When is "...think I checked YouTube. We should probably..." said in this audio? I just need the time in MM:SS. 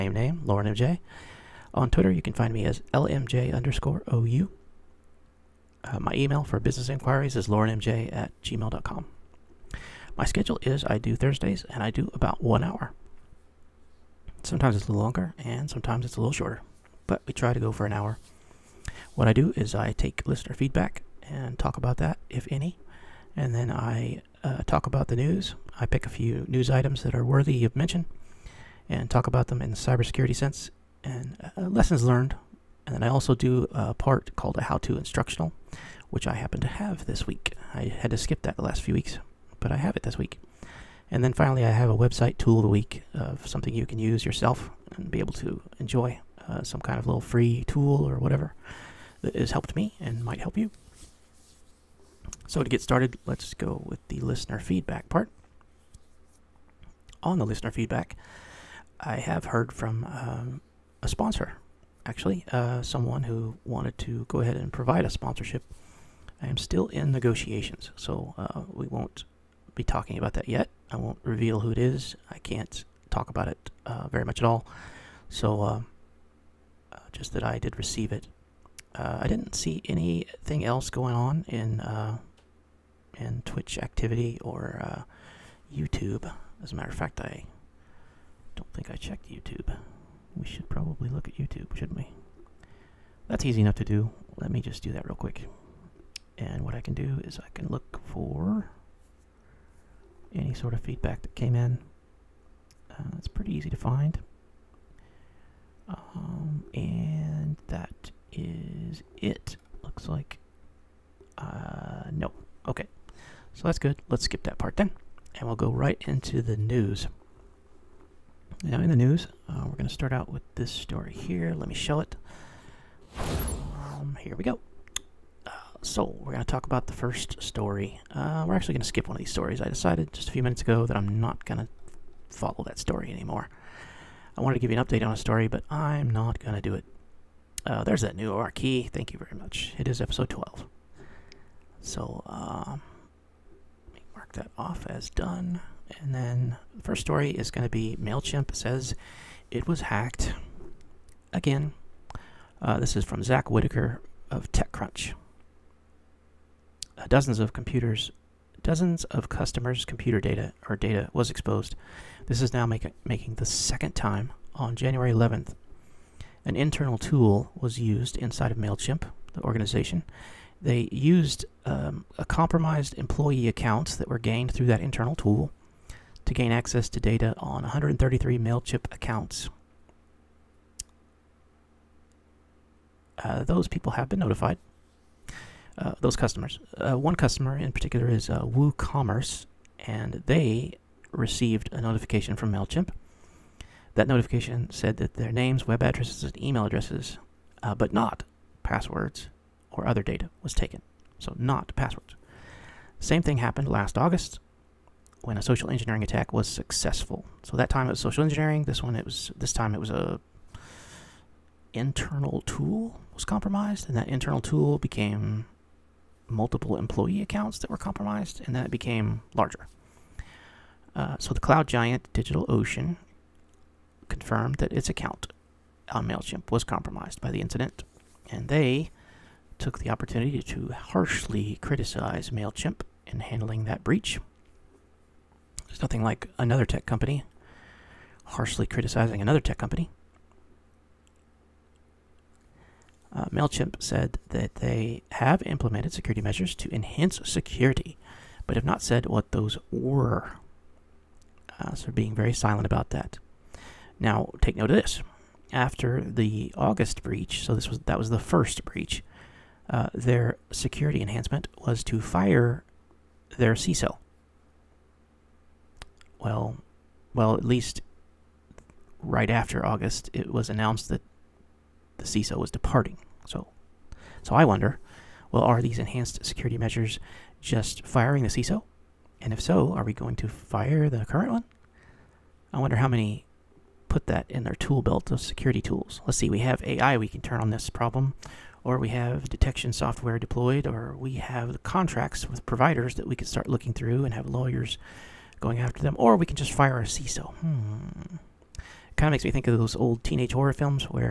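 01:28.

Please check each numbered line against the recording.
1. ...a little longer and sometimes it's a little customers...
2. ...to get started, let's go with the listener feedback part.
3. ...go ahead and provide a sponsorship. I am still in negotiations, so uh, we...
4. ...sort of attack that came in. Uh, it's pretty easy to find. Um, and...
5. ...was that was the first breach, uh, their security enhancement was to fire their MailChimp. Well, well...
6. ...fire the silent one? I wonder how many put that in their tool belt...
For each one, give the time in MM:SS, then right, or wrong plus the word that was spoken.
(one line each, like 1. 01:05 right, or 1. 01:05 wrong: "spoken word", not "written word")
1. 00:14 wrong: "shorter", not "customers"
2. 00:52 right
3. 01:04 right
4. 01:40 wrong: "feedback", not "attack"
5. 04:17 wrong: "CISO", not "MailChimp"
6. 04:40 wrong: "current", not "silent".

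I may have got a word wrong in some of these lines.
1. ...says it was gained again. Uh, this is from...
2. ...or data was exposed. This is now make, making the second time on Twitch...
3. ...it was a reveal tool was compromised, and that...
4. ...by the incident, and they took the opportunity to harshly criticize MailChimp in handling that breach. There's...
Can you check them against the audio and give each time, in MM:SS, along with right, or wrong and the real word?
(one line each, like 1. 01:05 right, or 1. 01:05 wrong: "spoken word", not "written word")
1. 02:28 wrong: "hacked", not "gained"
2. 02:40 wrong: "January", not "Twitch"
3. 03:29 wrong: "internal", not "reveal"
4. 03:47 right.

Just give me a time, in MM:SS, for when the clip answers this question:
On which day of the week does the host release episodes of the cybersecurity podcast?
00:11.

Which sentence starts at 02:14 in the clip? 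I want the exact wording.
I wanted to give you an update on a story, but I'm not going to do it.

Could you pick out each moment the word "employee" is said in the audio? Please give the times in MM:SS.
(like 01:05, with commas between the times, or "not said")
02:52, 03:36.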